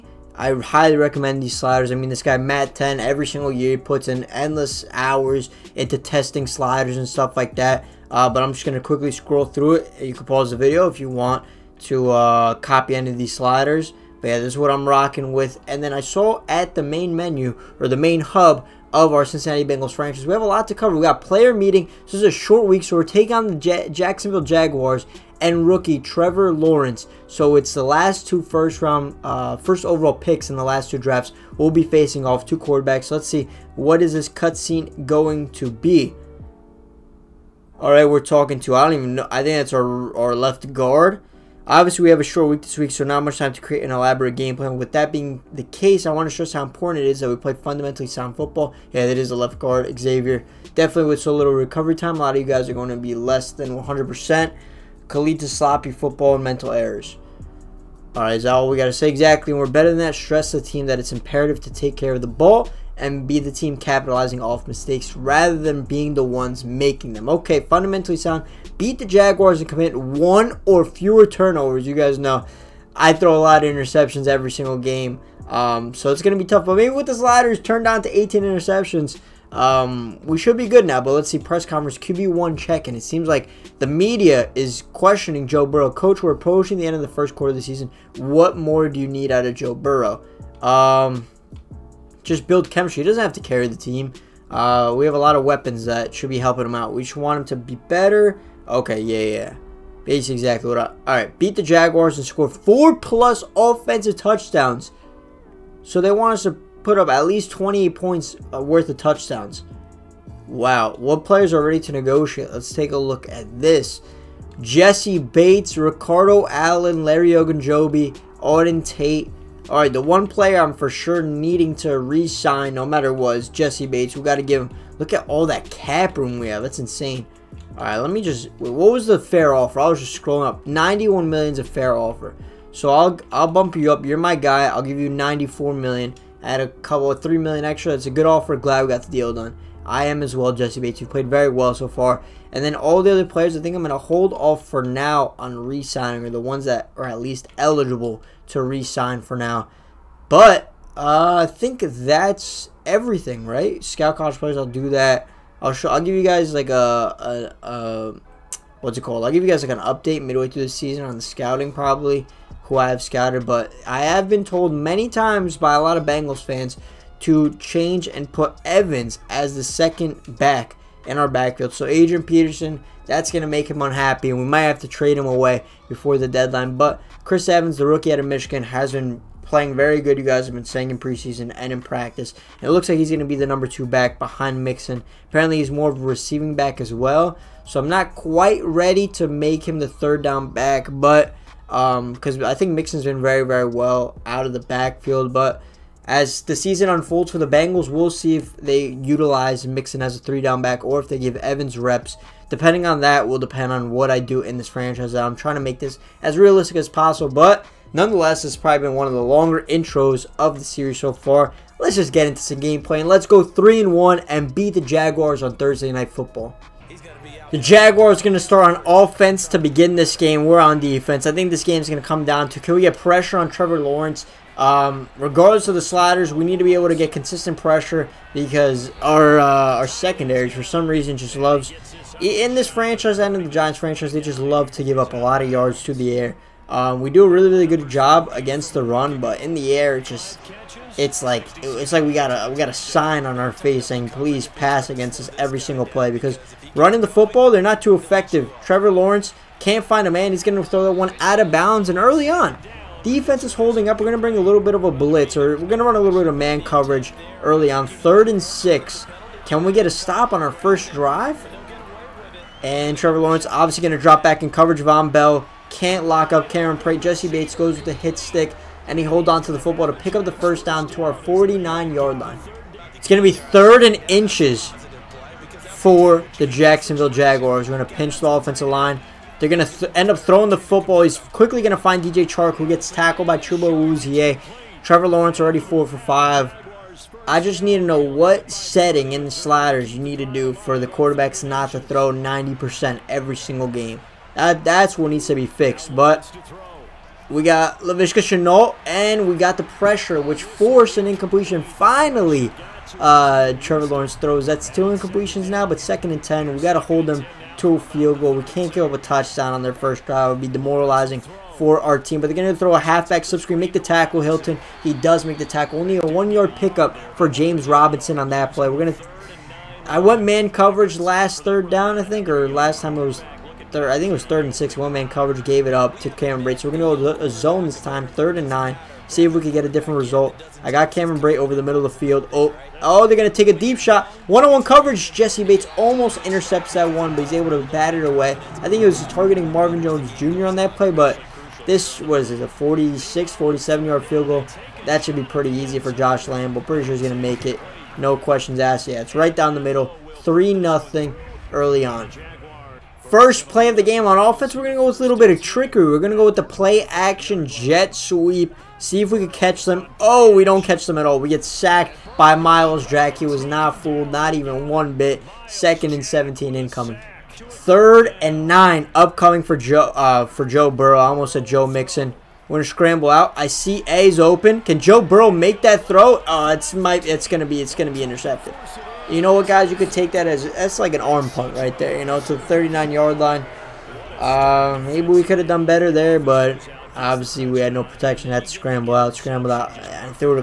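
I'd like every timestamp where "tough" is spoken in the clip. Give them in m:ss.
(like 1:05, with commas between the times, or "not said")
1:16.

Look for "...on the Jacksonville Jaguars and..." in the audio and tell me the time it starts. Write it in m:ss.
0:23.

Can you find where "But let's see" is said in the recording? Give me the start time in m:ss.
1:21.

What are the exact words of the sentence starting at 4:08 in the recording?
Trevor Lawrence can't find a man.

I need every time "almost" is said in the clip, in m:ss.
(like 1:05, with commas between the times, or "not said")
5:35, 6:11.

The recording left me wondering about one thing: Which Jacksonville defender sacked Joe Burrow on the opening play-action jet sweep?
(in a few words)
Myles Jack.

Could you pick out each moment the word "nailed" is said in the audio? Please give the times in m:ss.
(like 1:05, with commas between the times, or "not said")
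not said.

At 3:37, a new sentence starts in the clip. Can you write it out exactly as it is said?
The Jaguars going to start on offense to begin this game.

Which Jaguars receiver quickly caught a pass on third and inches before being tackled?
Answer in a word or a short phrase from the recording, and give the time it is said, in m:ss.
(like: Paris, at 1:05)
DJ Chark, at 4:42.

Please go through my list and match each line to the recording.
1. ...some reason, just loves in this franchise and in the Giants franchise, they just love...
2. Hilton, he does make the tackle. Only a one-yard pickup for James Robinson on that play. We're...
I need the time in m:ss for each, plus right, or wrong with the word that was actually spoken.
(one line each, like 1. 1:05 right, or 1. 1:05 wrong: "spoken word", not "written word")
1. 3:50 right
2. 5:14 right.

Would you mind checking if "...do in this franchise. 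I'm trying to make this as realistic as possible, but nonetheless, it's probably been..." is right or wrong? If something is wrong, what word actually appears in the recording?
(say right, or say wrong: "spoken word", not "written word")
right.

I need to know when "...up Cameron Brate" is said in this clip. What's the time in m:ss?
4:26.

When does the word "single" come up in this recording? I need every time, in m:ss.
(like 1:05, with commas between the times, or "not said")
0:03, 1:14, 4:05, 4:53.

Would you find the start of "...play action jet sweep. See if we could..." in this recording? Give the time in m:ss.
5:56.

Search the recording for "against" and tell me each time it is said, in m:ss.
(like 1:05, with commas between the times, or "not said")
3:58, 4:04.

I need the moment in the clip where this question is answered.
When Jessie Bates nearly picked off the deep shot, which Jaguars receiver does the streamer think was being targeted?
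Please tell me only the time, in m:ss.
5:39.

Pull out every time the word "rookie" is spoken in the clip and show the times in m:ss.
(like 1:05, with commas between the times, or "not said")
0:25, 2:57.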